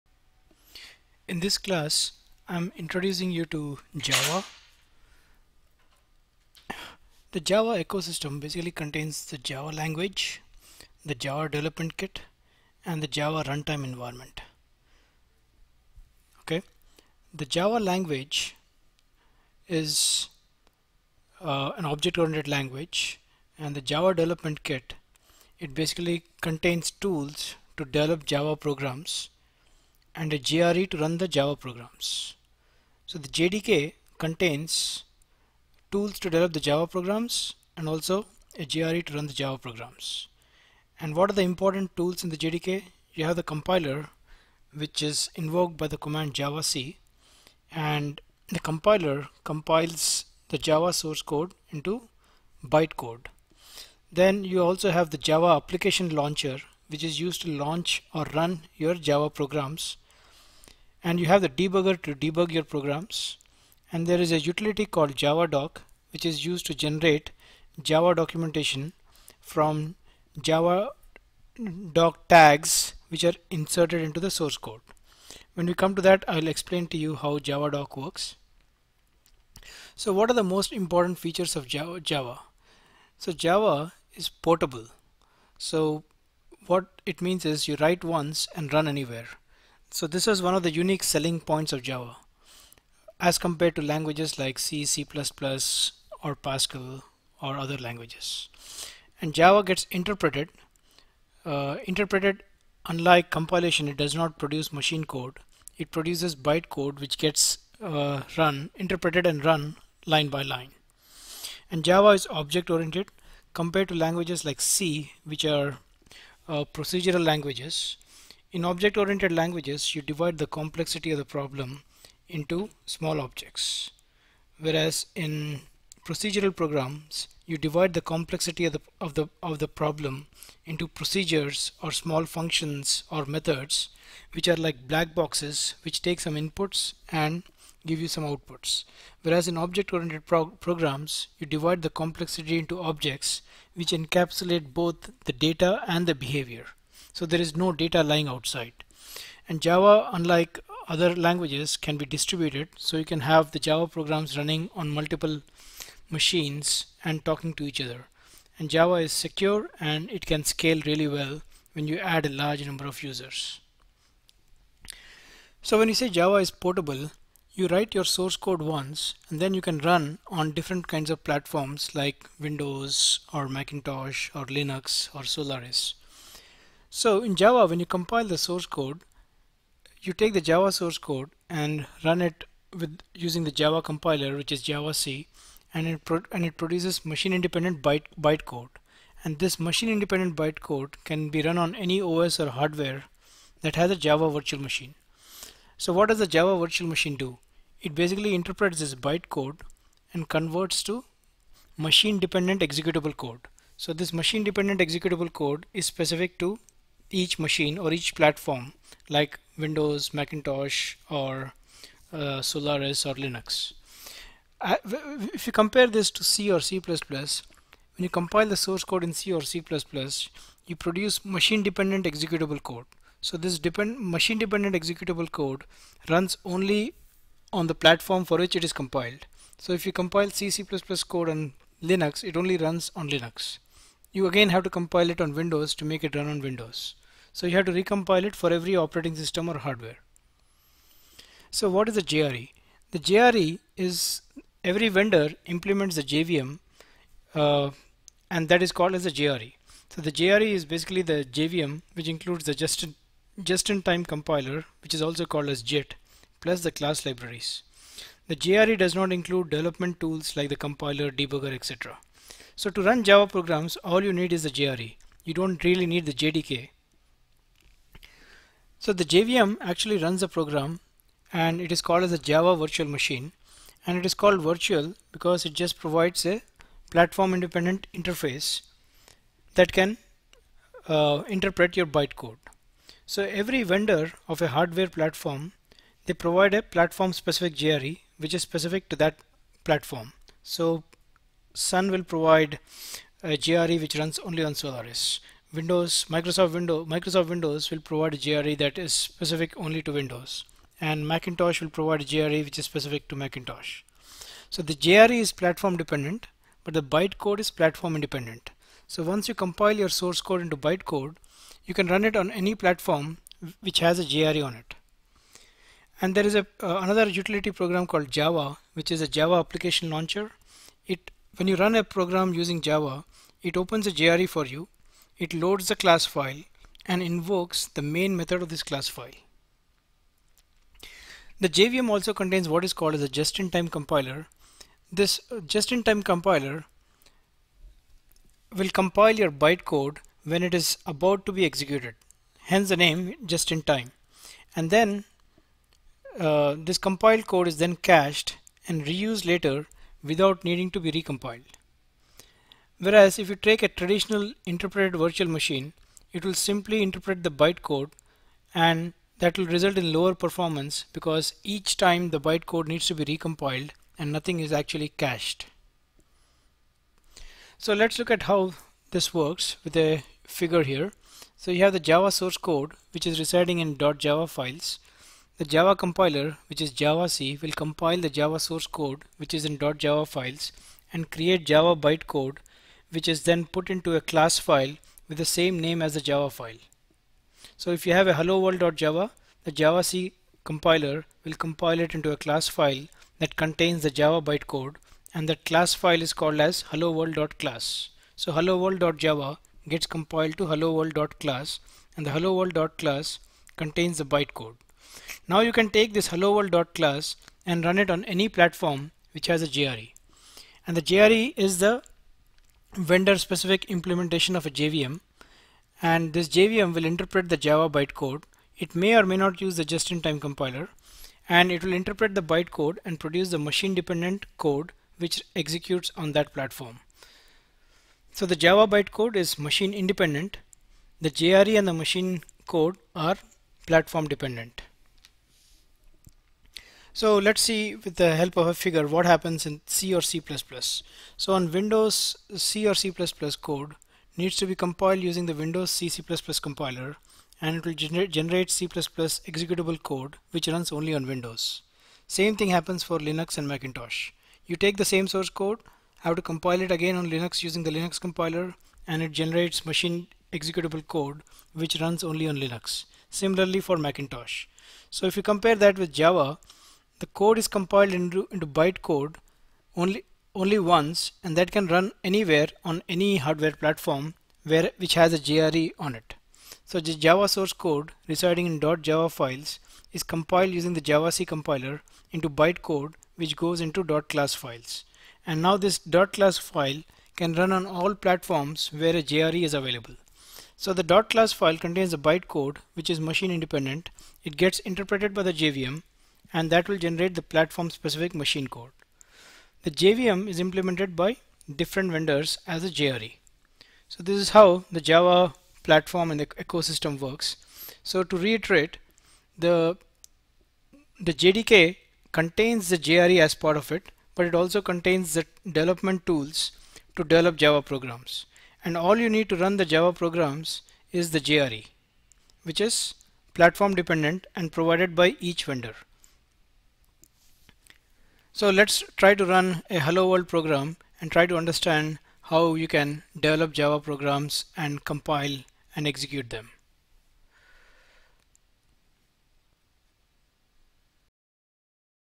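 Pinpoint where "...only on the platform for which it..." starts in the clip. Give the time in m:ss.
3:46.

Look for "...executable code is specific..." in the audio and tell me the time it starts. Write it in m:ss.
3:24.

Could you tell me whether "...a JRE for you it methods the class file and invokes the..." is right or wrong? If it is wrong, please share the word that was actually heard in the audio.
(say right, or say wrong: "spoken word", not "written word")
wrong: "loads", not "methods".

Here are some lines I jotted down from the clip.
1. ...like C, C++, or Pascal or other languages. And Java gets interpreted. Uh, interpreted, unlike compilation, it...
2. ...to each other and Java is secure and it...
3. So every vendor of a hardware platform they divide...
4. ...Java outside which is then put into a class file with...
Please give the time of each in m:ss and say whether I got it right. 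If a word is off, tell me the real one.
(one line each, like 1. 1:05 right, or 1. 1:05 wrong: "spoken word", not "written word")
1. 1:34 right
2. 2:37 right
3. 4:43 wrong: "provide", not "divide"
4. 6:21 wrong: "bytecode", not "outside".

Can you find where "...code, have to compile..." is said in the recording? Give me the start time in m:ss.
7:35.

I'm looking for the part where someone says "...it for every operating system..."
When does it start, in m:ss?
3:58.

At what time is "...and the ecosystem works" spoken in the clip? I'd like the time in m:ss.
8:26.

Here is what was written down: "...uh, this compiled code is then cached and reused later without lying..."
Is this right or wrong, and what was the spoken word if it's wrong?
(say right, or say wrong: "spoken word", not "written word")
wrong: "needing", not "lying".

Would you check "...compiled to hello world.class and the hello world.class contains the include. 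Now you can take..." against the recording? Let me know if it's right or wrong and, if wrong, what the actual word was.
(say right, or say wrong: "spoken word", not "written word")
wrong: "bytecode", not "include".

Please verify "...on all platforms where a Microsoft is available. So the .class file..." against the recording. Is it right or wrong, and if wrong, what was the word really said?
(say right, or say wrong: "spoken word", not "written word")
wrong: "JRE", not "Microsoft".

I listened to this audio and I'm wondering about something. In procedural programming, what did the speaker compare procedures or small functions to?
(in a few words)
black boxes.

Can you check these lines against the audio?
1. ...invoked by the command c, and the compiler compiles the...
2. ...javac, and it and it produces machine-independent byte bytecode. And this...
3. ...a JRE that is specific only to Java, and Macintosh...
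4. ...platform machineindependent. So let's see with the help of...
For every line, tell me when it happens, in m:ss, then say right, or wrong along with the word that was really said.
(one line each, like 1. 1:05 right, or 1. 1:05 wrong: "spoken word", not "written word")
1. 0:45 right
2. 3:04 right
3. 4:58 wrong: "Windows", not "Java"
4. 7:13 wrong: "dependent", not "machineindependent".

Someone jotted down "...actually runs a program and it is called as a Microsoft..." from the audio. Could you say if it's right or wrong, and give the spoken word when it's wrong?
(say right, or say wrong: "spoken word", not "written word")
wrong: "Java", not "Microsoft".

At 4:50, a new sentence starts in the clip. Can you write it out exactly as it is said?
So Sun will provide a JRE which runs only on Solaris.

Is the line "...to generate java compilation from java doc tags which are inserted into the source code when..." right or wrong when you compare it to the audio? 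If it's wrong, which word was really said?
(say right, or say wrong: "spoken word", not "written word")
wrong: "documentation", not "compilation".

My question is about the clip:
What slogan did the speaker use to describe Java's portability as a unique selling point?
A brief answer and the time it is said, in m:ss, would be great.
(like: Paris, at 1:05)
write once and run anywhere, at 1:27.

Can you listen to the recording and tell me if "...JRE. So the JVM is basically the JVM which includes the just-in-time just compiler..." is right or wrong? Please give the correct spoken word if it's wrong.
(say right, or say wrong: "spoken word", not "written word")
wrong: "JRE", not "JVM".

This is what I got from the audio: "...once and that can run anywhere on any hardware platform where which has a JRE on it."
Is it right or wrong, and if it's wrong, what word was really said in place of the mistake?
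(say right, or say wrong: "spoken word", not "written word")
right.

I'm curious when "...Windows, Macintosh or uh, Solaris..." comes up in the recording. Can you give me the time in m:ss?
3:29.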